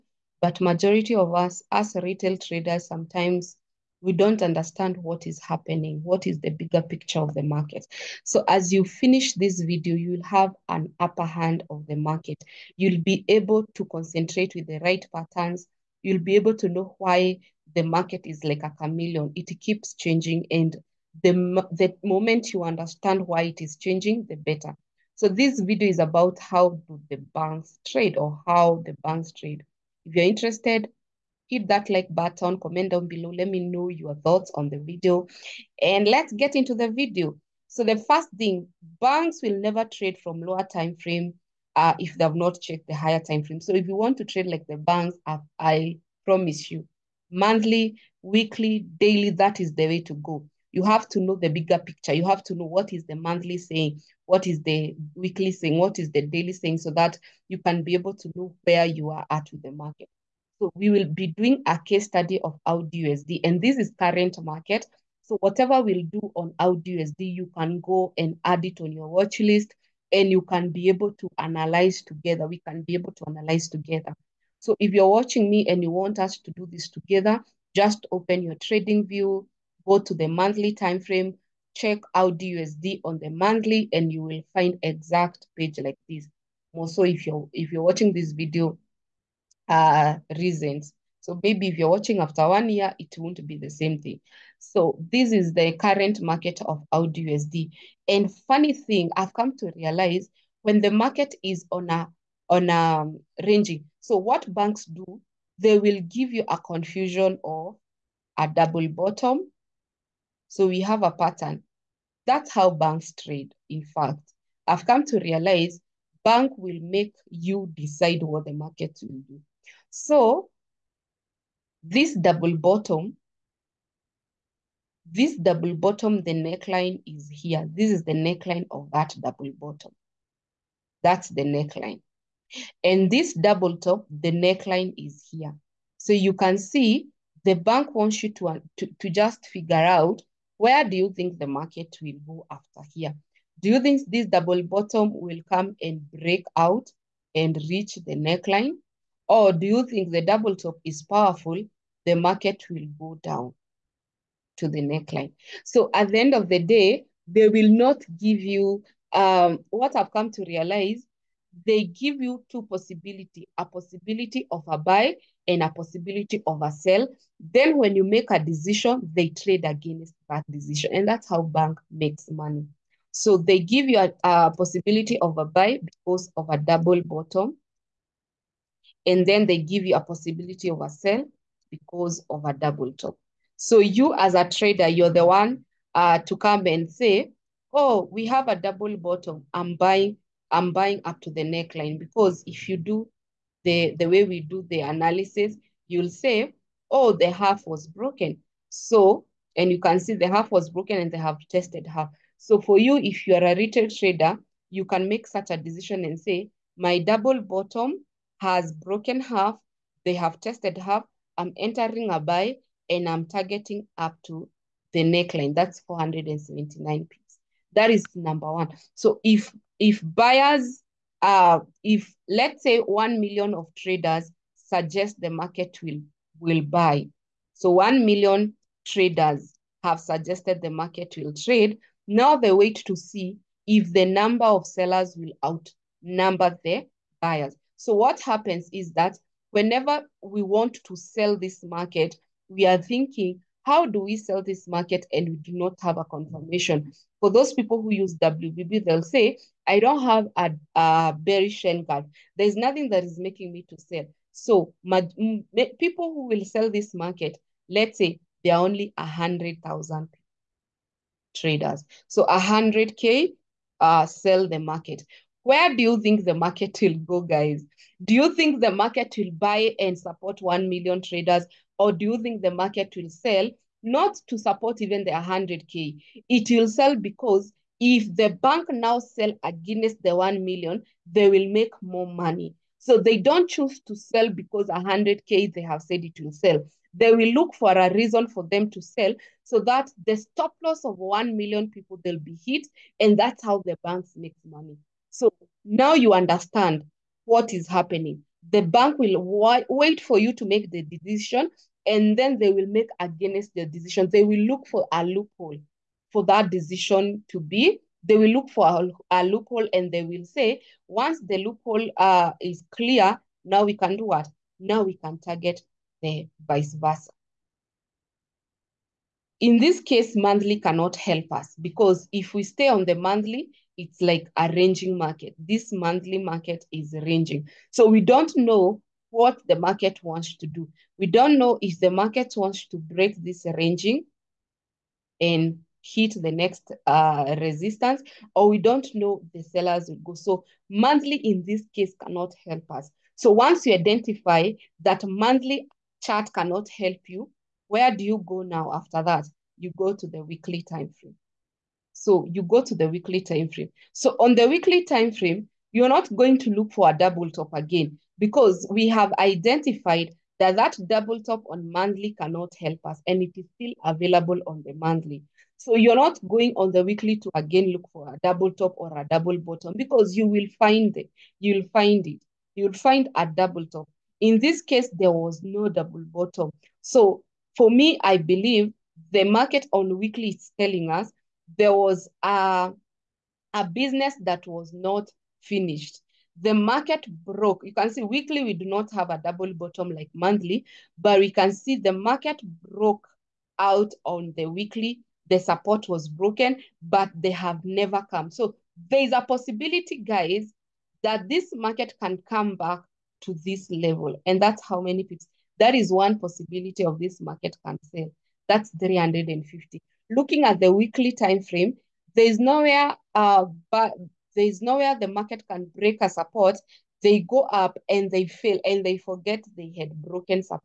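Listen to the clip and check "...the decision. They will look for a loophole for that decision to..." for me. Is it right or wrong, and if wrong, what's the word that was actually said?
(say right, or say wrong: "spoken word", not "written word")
right.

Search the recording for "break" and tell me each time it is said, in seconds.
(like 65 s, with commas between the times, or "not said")
146 s, 332 s, 415 s.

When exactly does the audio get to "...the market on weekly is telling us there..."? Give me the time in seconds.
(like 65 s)
379 s.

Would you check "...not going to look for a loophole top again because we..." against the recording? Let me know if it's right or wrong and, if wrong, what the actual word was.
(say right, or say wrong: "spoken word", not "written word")
wrong: "double", not "loophole".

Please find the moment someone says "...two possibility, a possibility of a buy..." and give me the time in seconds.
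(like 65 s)
162 s.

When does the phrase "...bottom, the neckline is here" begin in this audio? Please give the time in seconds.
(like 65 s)
125 s.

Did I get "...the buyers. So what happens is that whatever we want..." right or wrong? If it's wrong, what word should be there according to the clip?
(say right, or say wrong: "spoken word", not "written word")
wrong: "whenever", not "whatever".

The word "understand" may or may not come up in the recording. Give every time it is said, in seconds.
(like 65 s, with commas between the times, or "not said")
4 s, 22 s, 296 s.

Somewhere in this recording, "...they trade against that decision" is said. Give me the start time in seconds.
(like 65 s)
169 s.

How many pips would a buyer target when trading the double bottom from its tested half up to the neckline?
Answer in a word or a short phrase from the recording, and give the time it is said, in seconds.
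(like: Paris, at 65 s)
479, at 215 s.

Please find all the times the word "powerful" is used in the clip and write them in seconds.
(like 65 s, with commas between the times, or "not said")
151 s.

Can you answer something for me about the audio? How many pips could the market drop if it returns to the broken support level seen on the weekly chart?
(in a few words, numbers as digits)
350.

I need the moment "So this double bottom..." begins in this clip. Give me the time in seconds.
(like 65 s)
119 s.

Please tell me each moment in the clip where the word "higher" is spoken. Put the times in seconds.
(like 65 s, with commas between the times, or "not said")
42 s.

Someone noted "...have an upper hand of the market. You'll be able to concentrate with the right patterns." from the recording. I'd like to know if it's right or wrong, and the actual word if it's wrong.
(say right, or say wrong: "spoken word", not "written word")
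right.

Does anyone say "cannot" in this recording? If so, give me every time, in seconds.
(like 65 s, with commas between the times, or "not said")
320 s, 342 s, 346 s, 362 s.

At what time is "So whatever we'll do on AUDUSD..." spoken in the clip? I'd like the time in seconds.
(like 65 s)
65 s.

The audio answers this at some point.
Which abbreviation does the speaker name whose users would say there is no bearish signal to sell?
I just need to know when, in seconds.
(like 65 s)
248 s.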